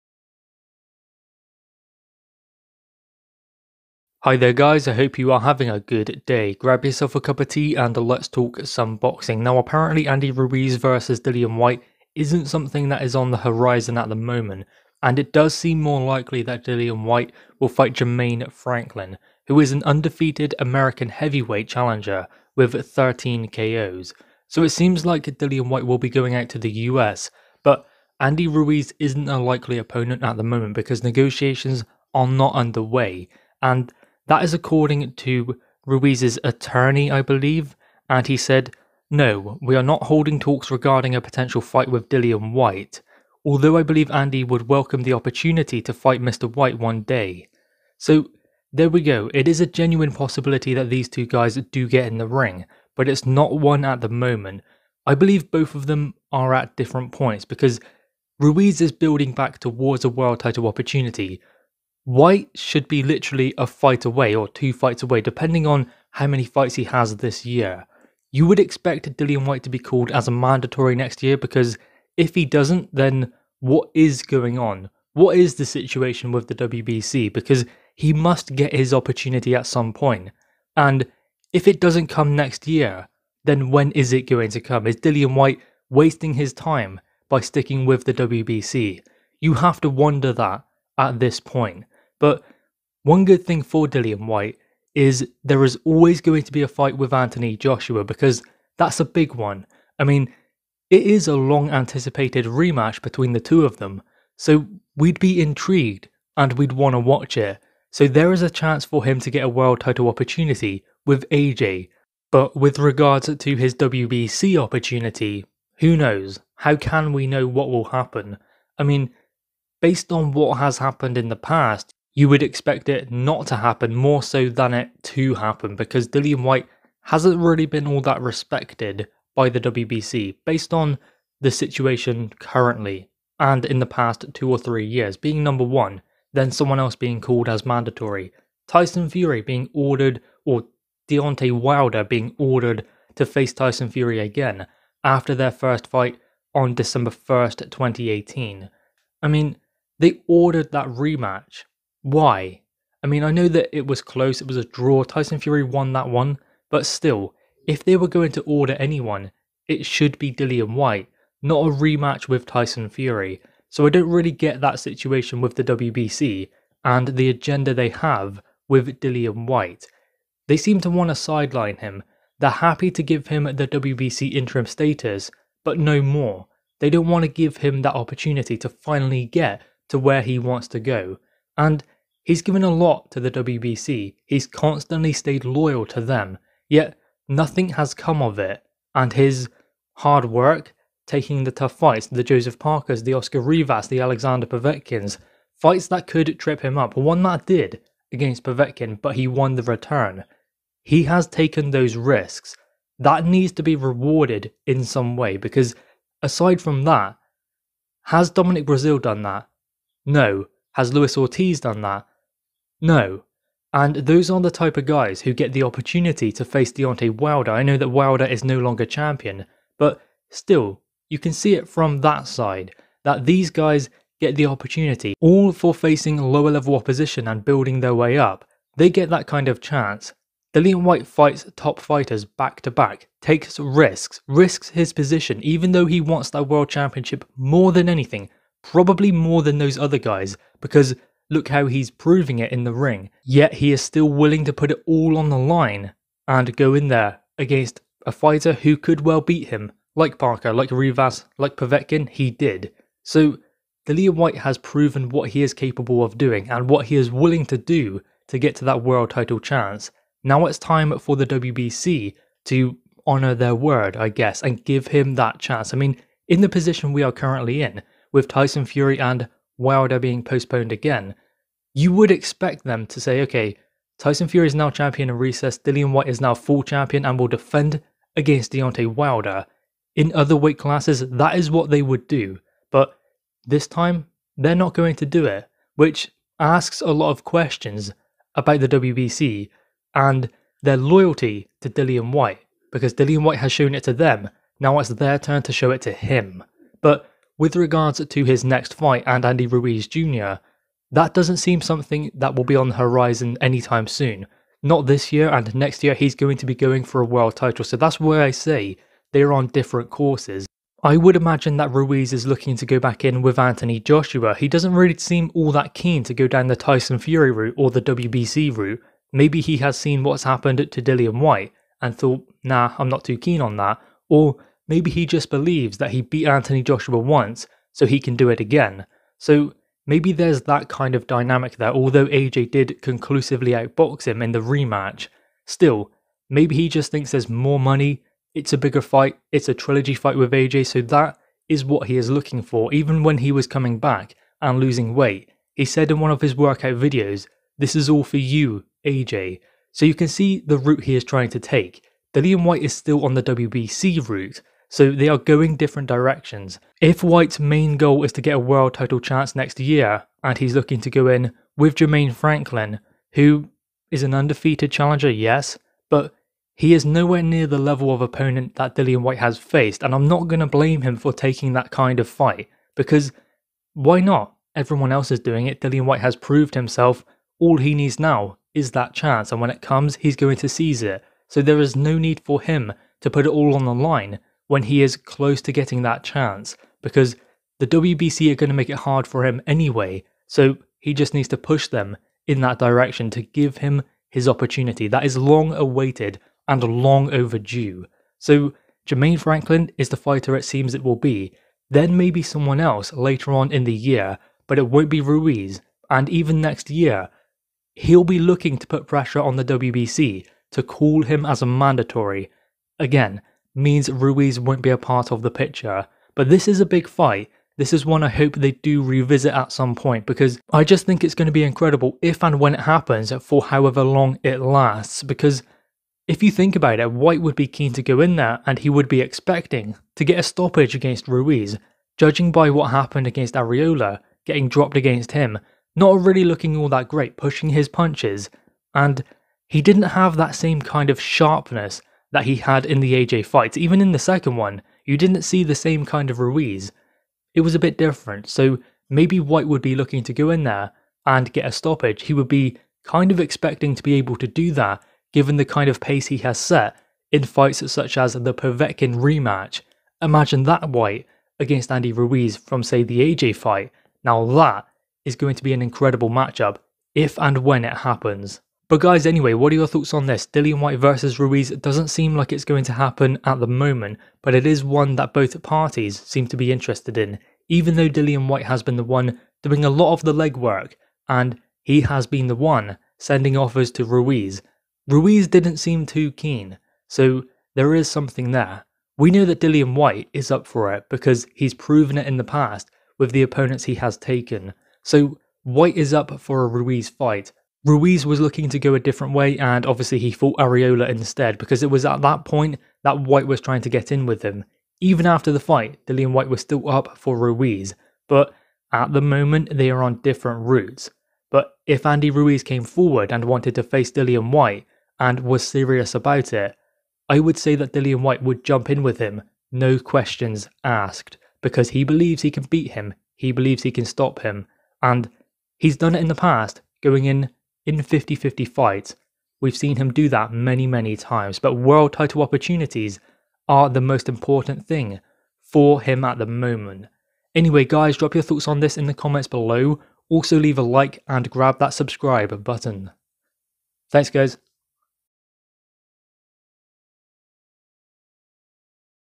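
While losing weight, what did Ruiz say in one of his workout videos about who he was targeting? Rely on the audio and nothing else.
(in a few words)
This is all for you, AJ.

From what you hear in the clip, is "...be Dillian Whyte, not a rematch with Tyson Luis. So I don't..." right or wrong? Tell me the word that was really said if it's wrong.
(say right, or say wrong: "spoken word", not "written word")
wrong: "Fury", not "Luis".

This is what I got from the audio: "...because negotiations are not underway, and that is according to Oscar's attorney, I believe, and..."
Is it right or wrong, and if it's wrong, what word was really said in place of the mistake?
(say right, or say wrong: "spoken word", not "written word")
wrong: "Ruiz", not "Oscar".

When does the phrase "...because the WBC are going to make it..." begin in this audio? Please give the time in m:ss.
6:26.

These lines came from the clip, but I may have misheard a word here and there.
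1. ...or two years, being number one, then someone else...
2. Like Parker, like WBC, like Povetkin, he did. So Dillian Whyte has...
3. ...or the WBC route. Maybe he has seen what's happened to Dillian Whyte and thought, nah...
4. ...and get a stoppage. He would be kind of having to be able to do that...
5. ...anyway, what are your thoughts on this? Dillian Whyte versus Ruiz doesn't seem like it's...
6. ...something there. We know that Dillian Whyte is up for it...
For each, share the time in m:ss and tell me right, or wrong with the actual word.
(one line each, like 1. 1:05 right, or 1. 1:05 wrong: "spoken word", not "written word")
1. 2:14 wrong: "three", not "two"
2. 4:09 wrong: "Rivas", not "WBC"
3. 5:17 right
4. 7:31 wrong: "expecting", not "having"
5. 7:49 right
6. 8:07 right.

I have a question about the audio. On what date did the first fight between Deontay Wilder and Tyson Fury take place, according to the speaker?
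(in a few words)
December 1st, 2018.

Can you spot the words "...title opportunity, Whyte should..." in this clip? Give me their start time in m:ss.
1:00.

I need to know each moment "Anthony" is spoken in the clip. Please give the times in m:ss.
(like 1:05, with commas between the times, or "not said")
1:37, 5:13, 5:26.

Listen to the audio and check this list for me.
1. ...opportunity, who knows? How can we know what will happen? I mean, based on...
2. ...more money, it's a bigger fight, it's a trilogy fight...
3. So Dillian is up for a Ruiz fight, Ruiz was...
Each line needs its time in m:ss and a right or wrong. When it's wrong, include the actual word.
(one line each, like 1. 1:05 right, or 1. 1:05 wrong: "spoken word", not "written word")
1. 1:54 right
2. 5:37 right
3. 8:14 wrong: "Whyte", not "Dillian".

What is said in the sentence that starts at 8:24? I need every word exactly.
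Even after the fight, Dillian Whyte was still up for Ruiz, but at the moment they are on different routes.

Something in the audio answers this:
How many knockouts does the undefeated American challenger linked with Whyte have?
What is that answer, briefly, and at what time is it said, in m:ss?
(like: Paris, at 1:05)
13, at 0:22.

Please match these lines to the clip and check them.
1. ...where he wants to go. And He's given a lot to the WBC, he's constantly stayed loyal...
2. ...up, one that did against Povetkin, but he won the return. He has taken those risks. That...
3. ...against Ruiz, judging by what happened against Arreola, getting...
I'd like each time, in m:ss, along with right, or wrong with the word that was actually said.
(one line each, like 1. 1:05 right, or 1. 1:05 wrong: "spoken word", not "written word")
1. 2:59 right
2. 3:16 right
3. 7:10 right.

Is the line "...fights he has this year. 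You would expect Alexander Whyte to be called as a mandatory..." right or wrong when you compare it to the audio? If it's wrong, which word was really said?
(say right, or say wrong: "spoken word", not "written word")
wrong: "Dillian", not "Alexander".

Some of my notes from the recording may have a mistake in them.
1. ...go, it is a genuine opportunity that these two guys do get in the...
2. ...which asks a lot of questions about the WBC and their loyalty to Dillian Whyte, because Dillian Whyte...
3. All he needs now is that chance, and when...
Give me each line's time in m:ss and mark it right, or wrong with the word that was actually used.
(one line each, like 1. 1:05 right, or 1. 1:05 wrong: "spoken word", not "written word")
1. 0:49 wrong: "possibility", not "opportunity"
2. 4:45 right
3. 6:17 right.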